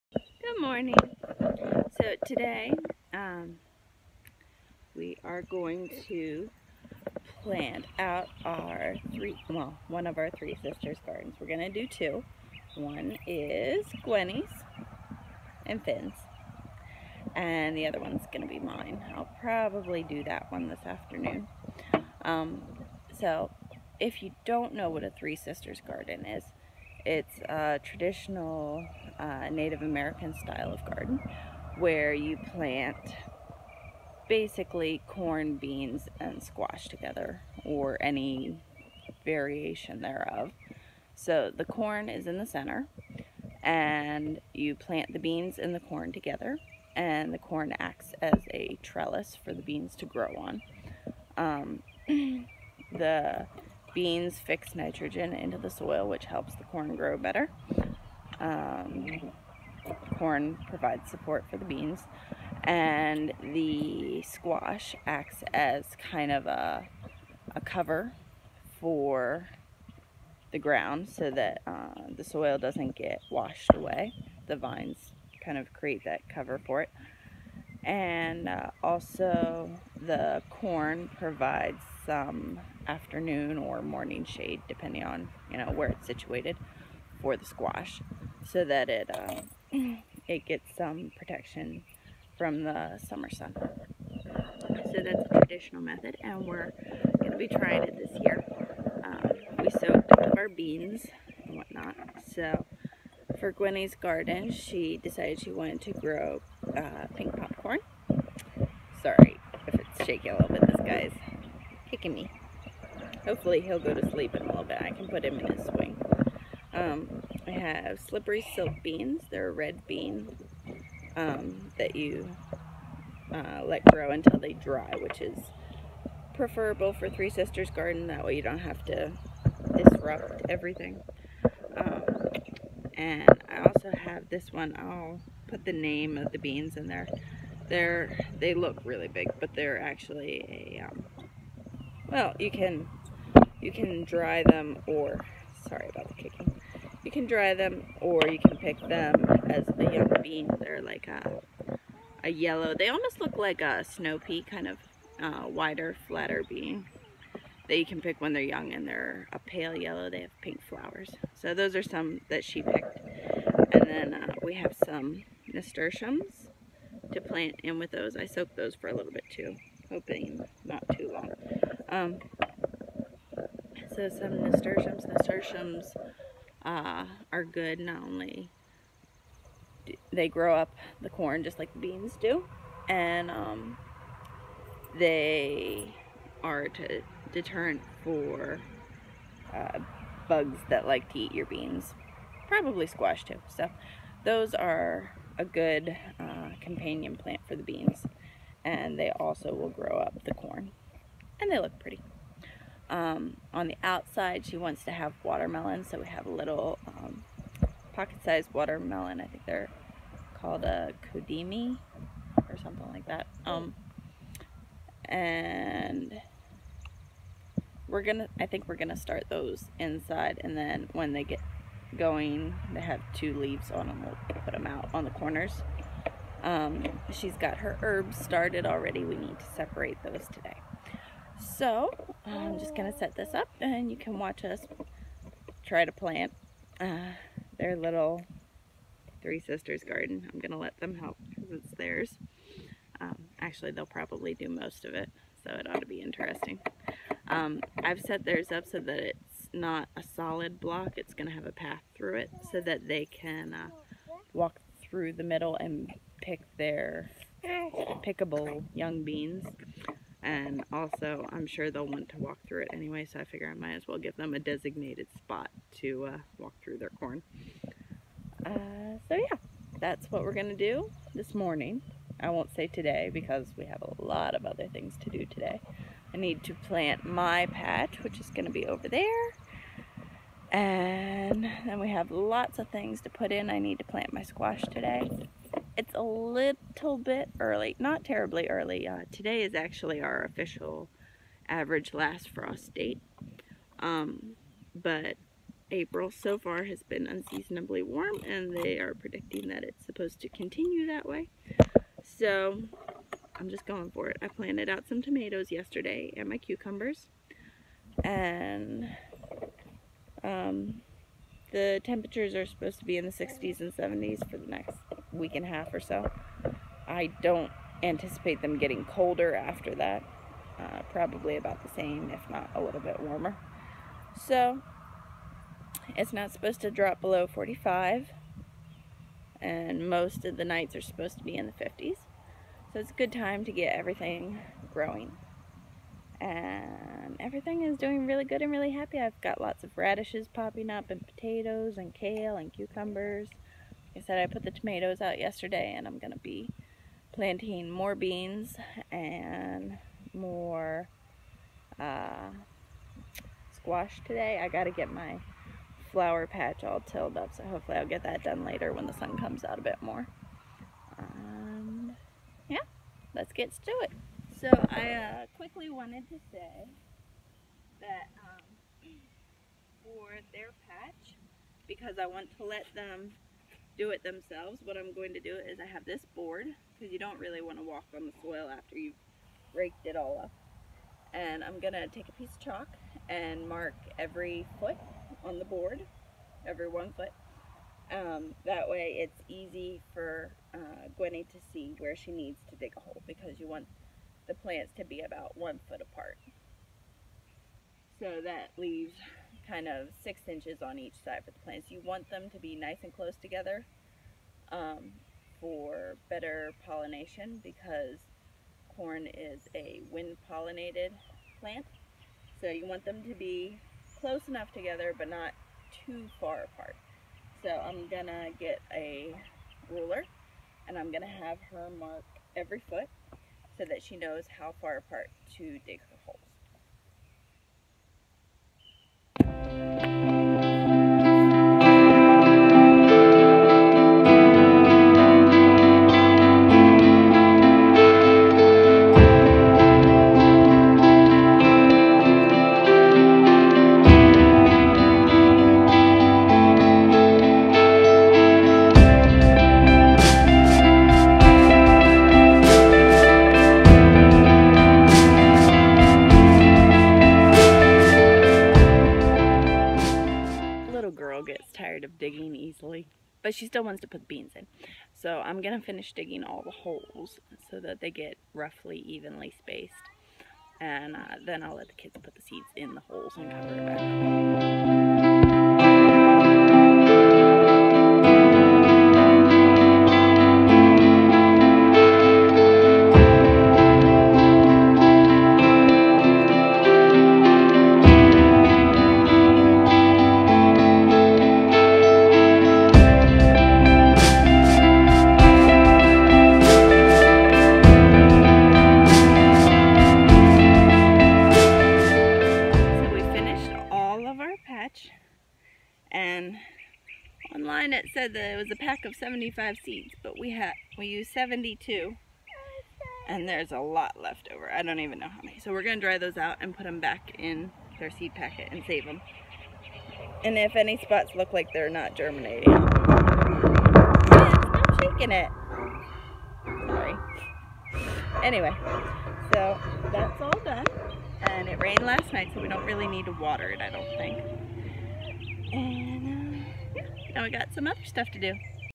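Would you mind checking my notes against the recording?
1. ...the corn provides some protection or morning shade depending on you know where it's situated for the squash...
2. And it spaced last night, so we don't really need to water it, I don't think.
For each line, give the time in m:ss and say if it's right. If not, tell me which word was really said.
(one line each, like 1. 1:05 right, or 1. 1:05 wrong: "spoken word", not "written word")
1. 1:20 wrong: "afternoon", not "protection"
2. 8:51 wrong: "rained", not "spaced".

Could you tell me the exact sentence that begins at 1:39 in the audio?
Um, we soaked our beans and whatnot.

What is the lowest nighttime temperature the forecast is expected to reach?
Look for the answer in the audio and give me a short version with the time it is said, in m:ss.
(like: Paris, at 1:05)
45, at 5:27.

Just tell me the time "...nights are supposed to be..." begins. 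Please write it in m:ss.
5:30.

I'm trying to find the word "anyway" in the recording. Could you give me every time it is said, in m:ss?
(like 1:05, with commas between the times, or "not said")
4:22, 8:48.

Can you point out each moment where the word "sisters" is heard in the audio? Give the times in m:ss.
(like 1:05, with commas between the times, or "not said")
0:10, 0:25, 2:07, 3:59.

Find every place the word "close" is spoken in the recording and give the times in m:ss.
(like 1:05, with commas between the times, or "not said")
6:42, 6:53.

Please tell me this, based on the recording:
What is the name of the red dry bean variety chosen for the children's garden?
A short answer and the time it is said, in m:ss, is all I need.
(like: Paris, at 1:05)
Slippery silk, at 1:58.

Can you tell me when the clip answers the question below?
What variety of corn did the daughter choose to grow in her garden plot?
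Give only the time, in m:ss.
1:47.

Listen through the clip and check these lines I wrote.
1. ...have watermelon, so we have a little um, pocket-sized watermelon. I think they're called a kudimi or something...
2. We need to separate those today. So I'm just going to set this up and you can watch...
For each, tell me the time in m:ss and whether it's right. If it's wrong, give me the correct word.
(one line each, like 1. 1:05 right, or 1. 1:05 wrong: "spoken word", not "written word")
1. 3:24 right
2. 3:49 right.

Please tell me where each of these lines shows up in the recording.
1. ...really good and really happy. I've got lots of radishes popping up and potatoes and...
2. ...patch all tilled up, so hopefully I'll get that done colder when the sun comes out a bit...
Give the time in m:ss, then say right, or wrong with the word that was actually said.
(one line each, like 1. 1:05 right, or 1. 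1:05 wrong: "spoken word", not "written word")
1. 5:38 right
2. 5:56 wrong: "later", not "colder".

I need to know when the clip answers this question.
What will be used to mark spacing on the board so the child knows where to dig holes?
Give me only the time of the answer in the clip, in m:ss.
6:22.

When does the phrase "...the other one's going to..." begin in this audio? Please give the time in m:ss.
0:17.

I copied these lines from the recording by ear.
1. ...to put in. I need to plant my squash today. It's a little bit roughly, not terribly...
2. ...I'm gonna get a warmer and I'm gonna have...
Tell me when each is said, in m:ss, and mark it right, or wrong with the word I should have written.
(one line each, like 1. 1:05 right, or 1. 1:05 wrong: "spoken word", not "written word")
1. 4:43 wrong: "early", not "roughly"
2. 6:57 wrong: "ruler", not "warmer".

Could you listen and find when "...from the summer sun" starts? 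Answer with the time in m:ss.
1:32.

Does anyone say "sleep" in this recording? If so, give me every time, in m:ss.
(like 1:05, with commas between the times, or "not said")
1:54.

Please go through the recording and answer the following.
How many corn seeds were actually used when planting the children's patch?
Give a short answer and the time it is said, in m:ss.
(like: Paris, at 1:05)
72, at 8:31.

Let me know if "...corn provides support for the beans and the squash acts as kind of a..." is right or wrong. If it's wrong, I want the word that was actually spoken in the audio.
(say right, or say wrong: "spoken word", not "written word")
right.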